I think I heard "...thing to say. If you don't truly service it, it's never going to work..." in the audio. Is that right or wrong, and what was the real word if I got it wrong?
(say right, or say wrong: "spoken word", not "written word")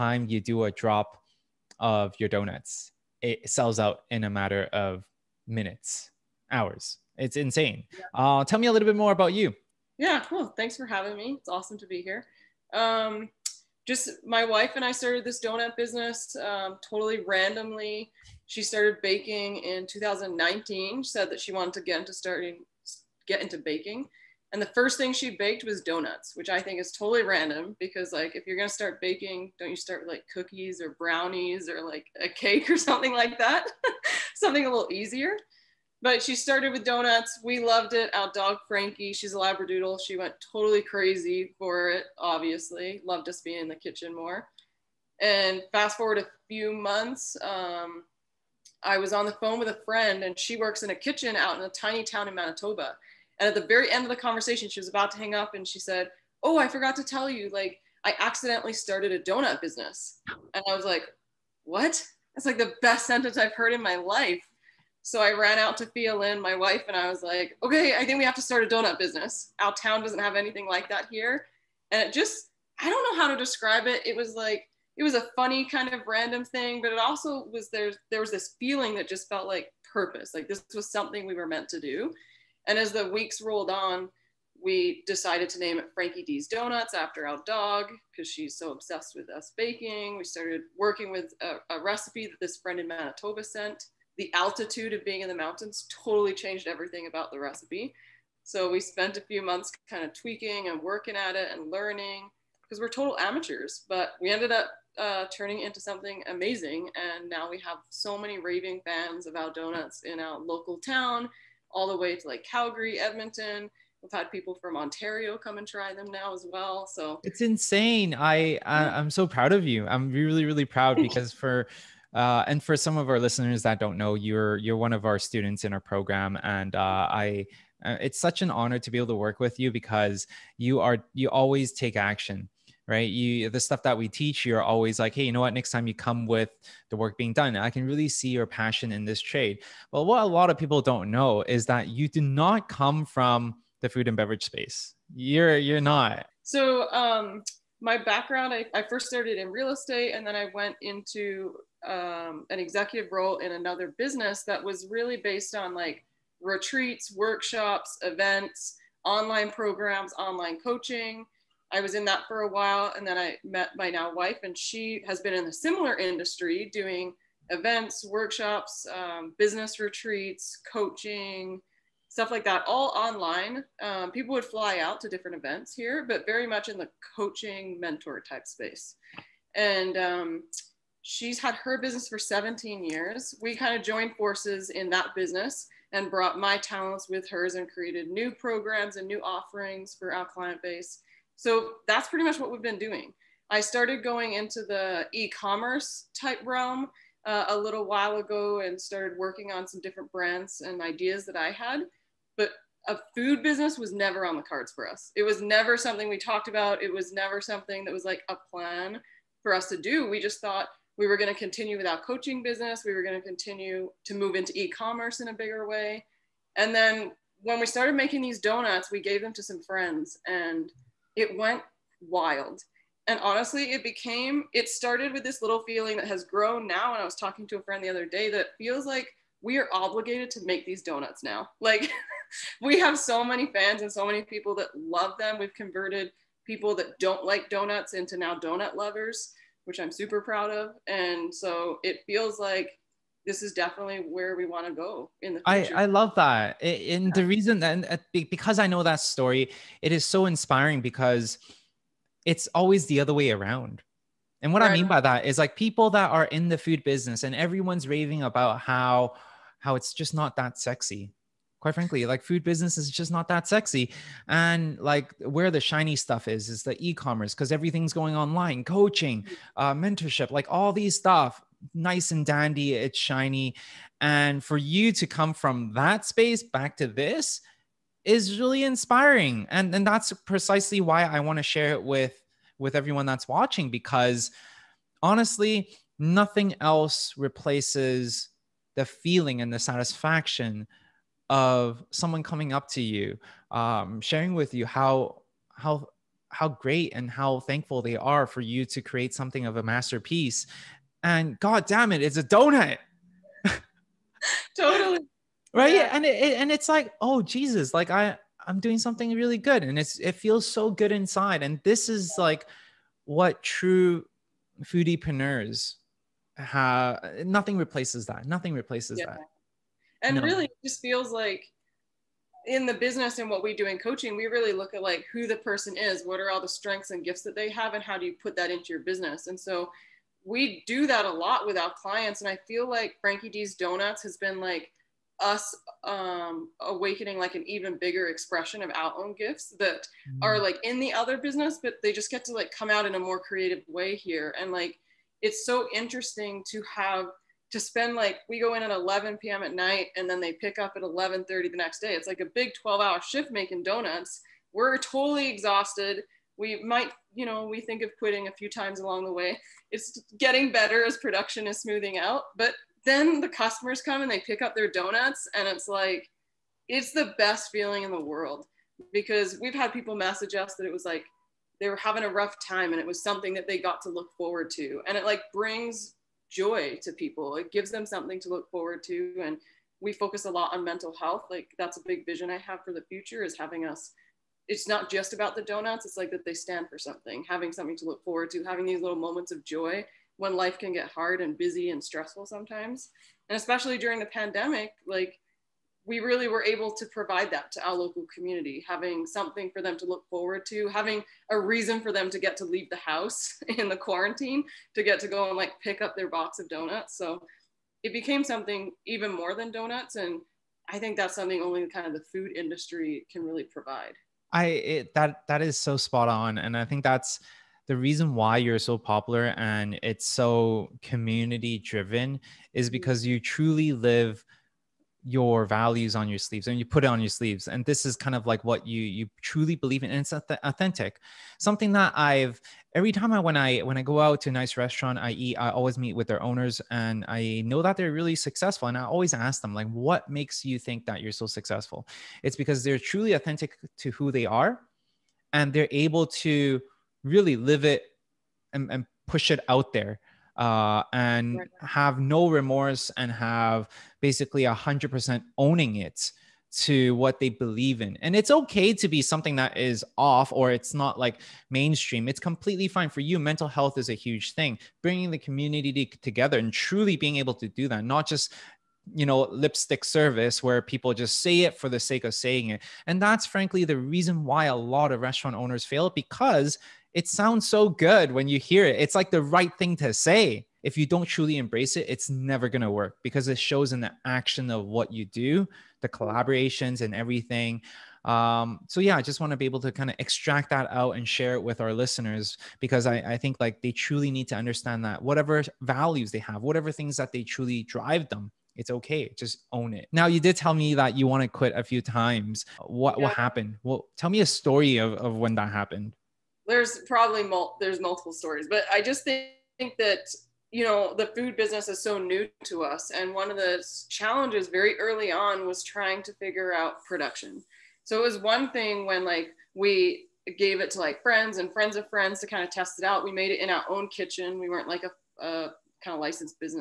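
wrong: "embrace", not "service".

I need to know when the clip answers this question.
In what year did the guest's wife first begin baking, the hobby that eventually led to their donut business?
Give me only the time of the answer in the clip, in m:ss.
0:19.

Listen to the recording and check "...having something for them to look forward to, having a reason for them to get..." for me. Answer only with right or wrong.
right.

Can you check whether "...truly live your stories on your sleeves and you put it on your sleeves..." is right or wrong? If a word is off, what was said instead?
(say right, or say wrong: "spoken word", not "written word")
wrong: "values", not "stories".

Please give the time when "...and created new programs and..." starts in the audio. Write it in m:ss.
3:07.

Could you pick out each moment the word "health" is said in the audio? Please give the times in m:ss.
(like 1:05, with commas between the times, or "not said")
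6:20, 7:43.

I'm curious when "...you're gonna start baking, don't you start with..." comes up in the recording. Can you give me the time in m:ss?
0:28.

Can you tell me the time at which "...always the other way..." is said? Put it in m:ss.
4:12.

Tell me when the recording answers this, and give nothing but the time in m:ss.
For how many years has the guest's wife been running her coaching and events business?
3:02.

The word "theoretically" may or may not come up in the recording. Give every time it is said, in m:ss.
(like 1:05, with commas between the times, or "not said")
not said.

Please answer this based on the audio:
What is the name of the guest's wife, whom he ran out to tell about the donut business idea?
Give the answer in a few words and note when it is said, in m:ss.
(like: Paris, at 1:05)
Fia Lynn, at 1:05.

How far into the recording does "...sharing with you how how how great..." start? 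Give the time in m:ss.
4:54.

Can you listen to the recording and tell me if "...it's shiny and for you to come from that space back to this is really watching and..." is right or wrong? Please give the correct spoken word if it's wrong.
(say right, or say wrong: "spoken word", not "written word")
wrong: "inspiring", not "watching".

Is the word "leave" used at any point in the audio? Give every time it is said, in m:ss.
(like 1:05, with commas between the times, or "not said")
6:42.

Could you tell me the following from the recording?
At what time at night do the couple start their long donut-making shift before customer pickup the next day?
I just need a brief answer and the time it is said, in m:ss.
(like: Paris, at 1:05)
11 p.m., at 5:48.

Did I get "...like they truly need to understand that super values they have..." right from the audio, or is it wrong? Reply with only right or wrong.
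wrong.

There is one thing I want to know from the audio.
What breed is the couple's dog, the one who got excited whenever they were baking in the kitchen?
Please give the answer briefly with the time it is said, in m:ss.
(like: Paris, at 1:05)
Labradoodle, at 0:39.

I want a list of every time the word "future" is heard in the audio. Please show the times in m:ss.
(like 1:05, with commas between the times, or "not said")
4:05, 6:22.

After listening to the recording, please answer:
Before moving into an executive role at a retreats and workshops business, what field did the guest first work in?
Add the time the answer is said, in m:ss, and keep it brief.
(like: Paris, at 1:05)
Real estate, at 2:29.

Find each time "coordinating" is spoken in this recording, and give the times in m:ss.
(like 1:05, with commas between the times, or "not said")
not said.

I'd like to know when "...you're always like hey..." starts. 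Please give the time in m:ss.
2:14.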